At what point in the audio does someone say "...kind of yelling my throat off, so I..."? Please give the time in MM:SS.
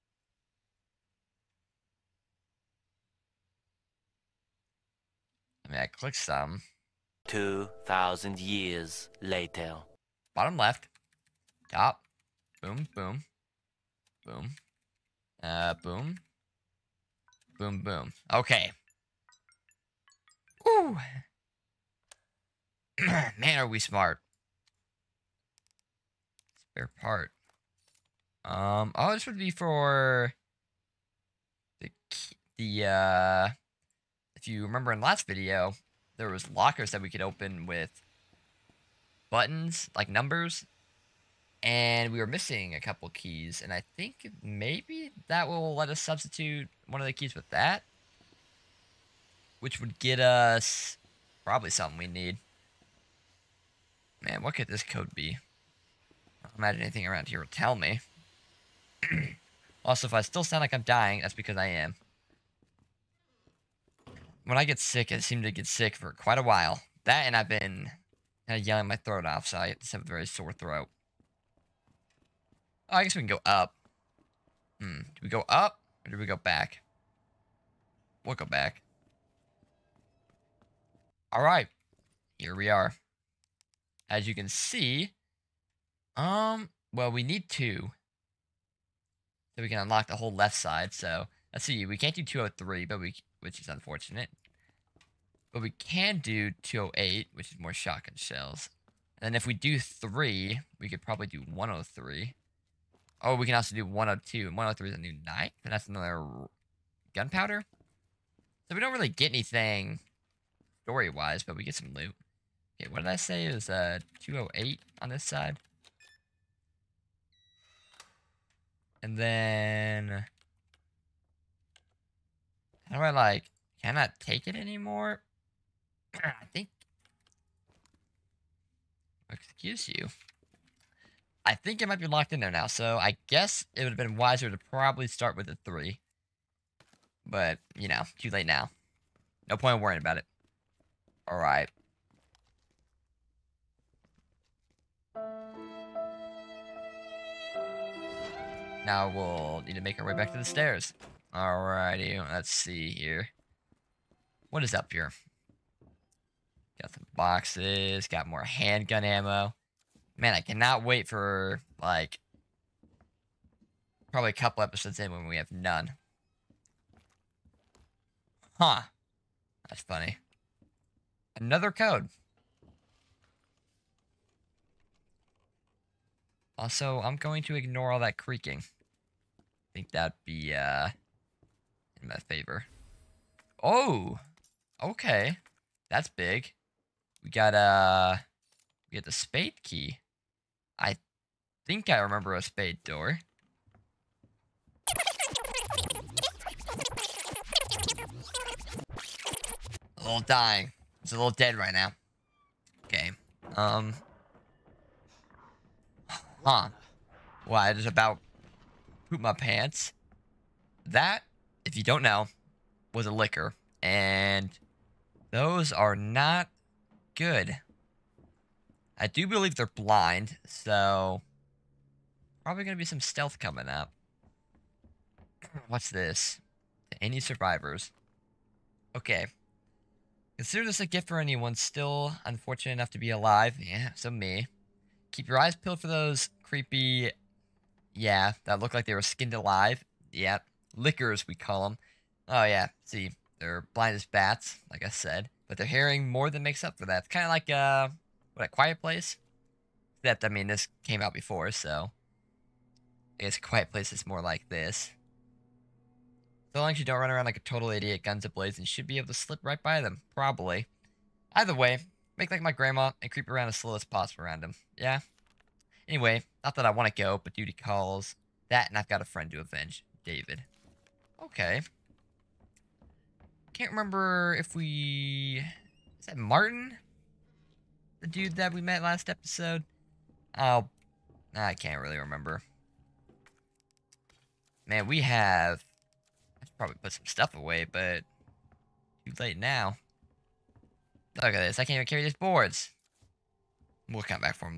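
01:08.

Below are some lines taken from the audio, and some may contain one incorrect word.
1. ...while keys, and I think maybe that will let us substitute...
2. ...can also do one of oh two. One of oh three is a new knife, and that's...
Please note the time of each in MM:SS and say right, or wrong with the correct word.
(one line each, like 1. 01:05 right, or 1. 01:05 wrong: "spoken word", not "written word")
1. 00:42 wrong: "couple", not "while"
2. 01:43 right.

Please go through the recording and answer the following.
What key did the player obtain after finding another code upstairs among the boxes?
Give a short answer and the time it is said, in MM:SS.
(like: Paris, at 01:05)
spade key, at 03:09.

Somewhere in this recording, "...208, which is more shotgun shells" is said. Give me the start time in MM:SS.
01:36.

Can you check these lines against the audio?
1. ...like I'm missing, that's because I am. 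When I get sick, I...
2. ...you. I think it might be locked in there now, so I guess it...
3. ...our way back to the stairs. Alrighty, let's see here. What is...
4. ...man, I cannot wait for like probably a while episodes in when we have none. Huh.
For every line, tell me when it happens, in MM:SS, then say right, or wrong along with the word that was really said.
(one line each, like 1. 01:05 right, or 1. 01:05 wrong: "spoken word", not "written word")
1. 01:00 wrong: "dying", not "missing"
2. 02:09 right
3. 02:30 right
4. 02:40 wrong: "couple", not "while".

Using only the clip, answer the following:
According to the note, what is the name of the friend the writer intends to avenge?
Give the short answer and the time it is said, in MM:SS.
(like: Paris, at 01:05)
David, at 04:30.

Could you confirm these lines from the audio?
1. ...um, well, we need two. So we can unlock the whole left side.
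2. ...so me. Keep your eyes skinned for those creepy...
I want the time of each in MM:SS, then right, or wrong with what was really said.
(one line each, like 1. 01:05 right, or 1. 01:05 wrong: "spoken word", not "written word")
1. 01:26 right
2. 03:53 wrong: "peeled", not "skinned".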